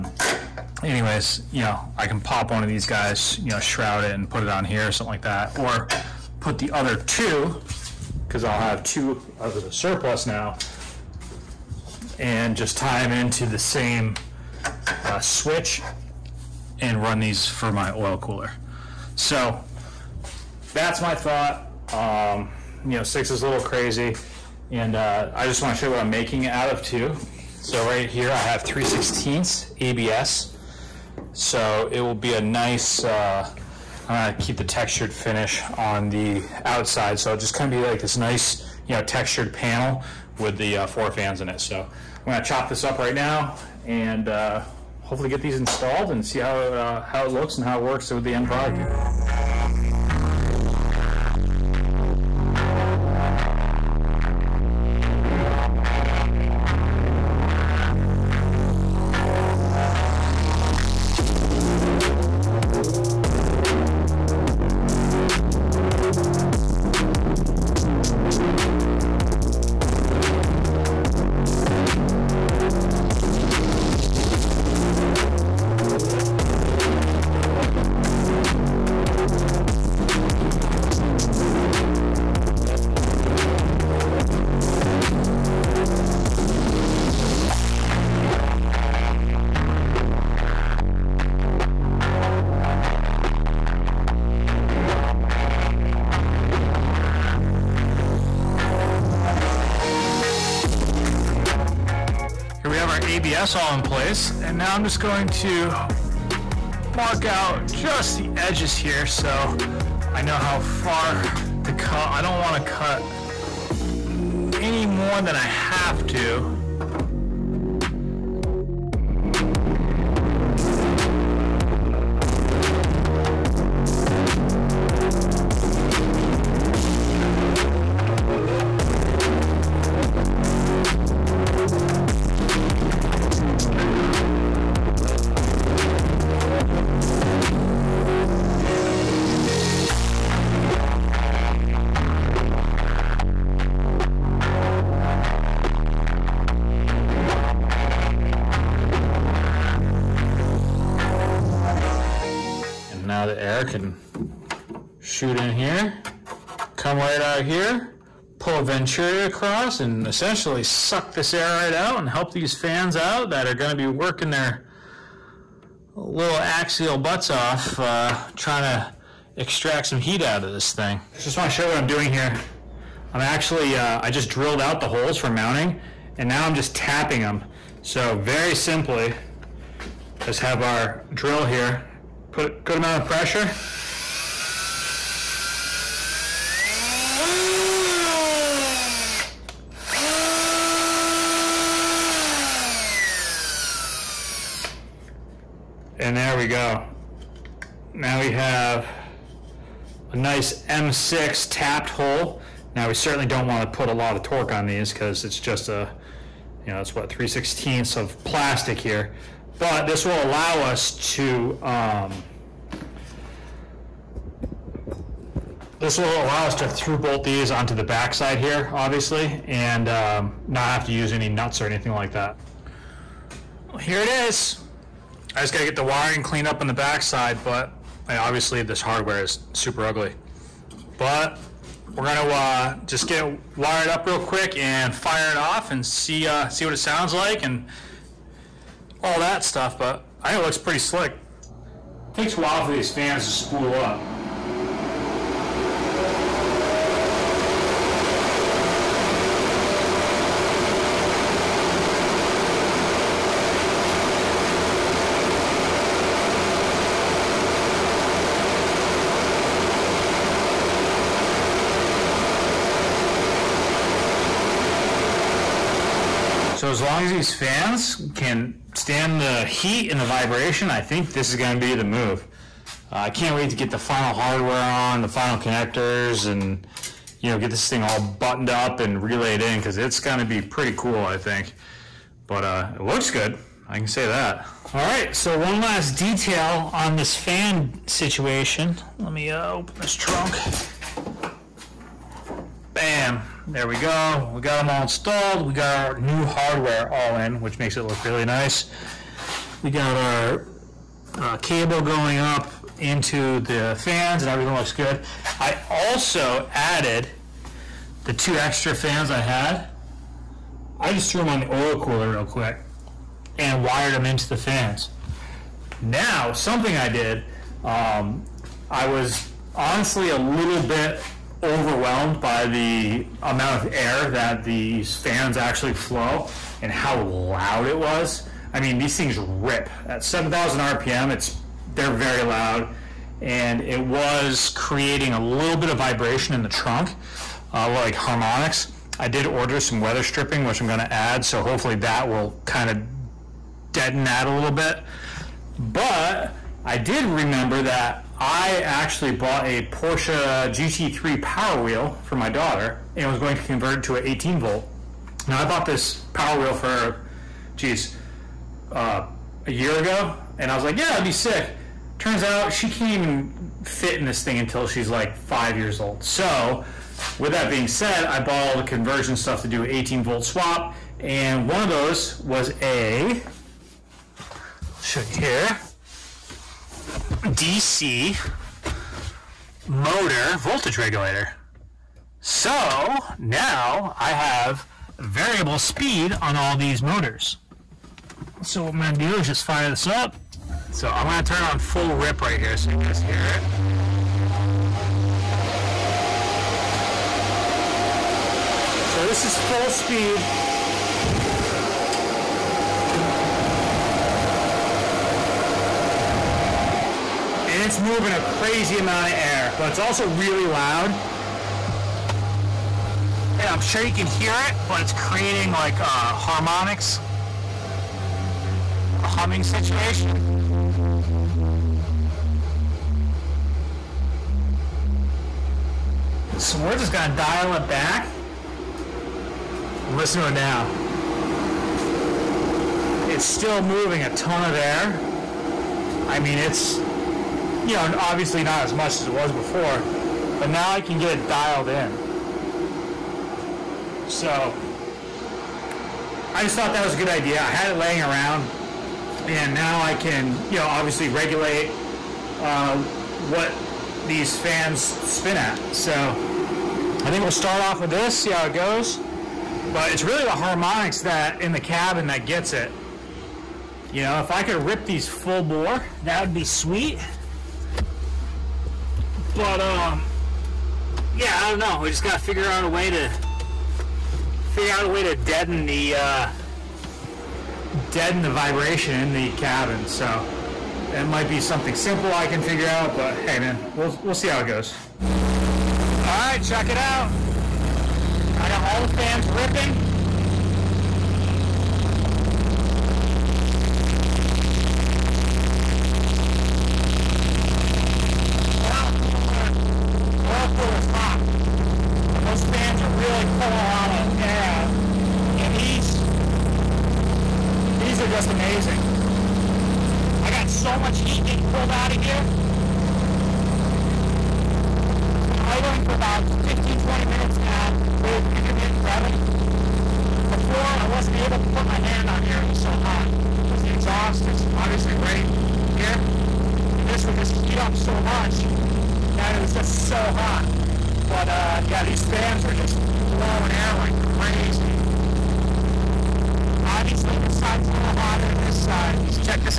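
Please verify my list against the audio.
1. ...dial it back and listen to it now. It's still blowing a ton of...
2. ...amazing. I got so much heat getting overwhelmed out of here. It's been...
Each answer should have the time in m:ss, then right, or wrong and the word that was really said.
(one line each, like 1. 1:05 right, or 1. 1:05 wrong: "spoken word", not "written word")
1. 7:07 wrong: "moving", not "blowing"
2. 8:28 wrong: "pulled", not "overwhelmed".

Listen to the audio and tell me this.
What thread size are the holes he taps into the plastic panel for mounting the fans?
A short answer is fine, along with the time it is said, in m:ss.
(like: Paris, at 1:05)
M6, at 3:20.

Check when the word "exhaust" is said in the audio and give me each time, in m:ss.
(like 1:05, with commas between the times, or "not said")
8:43.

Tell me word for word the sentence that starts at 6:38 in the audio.
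So this is full speed and it's moving a crazy amount of air, but it's also really loud.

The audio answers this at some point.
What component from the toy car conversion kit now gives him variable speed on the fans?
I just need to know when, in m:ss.
6:17.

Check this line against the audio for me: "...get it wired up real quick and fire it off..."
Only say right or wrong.
right.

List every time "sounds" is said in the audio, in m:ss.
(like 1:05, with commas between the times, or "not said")
3:56.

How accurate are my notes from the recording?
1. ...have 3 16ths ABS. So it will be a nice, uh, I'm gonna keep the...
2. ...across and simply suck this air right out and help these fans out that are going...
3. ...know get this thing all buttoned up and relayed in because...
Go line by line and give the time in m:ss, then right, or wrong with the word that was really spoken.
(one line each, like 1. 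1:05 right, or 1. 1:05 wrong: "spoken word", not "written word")
1. 0:28 right
2. 2:39 wrong: "essentially", not "simply"
3. 4:37 right.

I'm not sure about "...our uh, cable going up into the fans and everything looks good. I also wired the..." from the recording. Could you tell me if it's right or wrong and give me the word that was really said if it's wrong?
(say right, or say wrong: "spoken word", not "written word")
wrong: "added", not "wired".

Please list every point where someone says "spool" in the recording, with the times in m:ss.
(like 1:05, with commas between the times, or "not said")
4:03.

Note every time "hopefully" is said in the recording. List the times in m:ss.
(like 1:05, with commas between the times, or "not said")
0:45, 5:41.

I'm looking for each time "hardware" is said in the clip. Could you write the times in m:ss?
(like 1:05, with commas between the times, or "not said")
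3:48, 4:34, 4:56.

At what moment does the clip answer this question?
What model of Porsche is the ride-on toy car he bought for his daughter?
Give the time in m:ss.
5:50.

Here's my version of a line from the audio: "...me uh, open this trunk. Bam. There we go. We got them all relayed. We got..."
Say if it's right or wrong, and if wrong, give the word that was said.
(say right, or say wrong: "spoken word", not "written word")
wrong: "installed", not "relayed".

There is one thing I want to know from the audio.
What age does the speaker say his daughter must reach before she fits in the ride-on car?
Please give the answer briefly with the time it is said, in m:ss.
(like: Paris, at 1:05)
5, at 6:05.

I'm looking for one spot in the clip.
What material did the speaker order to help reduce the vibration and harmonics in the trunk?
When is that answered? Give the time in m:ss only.
5:39.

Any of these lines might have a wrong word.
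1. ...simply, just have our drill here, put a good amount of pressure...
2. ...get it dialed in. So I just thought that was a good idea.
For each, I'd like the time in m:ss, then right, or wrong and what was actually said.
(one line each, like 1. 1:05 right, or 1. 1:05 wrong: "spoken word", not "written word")
1. 2:58 right
2. 7:20 right.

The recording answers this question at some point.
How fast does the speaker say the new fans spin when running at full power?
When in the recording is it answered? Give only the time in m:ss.
5:30.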